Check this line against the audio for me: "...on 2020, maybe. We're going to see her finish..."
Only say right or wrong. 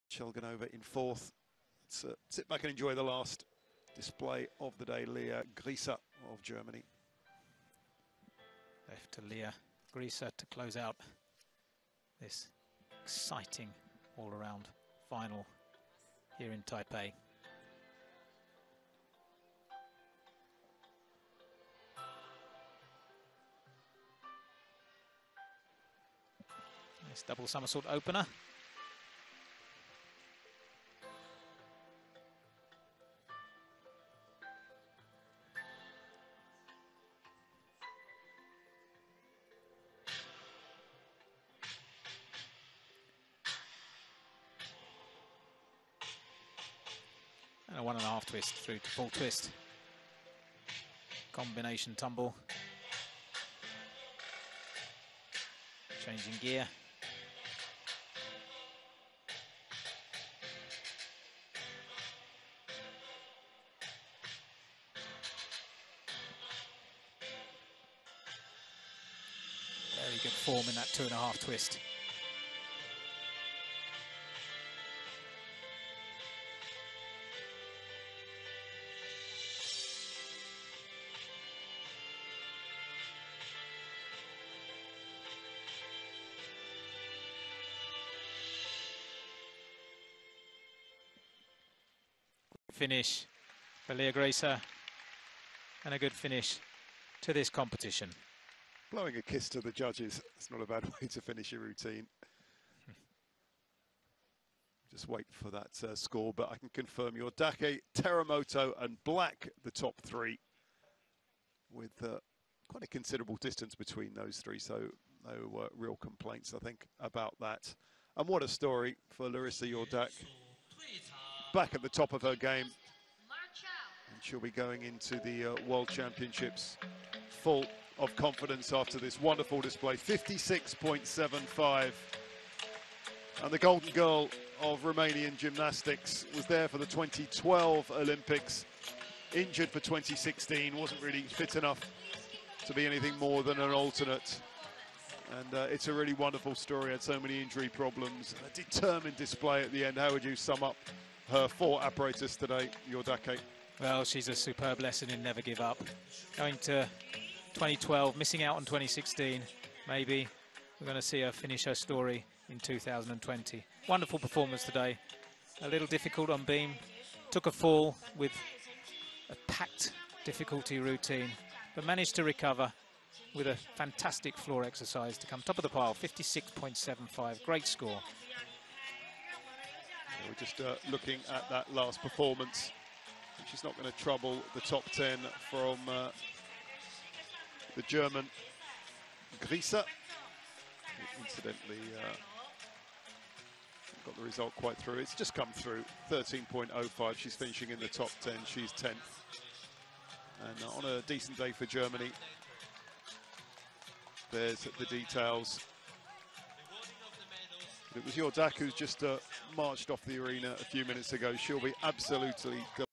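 wrong.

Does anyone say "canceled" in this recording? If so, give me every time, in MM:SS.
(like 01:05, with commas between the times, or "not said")
not said.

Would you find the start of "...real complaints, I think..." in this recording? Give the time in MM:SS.
01:55.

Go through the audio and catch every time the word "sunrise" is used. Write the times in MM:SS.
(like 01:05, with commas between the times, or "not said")
not said.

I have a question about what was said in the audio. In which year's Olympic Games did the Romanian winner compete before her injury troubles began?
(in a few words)
2012.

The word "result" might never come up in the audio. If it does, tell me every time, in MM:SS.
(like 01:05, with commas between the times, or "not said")
03:14.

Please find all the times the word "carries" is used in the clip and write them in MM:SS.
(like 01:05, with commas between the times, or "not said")
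not said.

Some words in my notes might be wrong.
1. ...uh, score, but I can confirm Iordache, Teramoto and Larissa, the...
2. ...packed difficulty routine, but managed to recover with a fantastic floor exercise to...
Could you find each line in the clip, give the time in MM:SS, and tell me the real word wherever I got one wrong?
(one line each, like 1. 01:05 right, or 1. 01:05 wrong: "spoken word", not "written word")
1. 01:45 wrong: "Black", not "Larissa"
2. 02:49 right.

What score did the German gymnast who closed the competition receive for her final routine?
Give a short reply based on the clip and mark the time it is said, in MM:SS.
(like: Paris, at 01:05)
13.05, at 03:16.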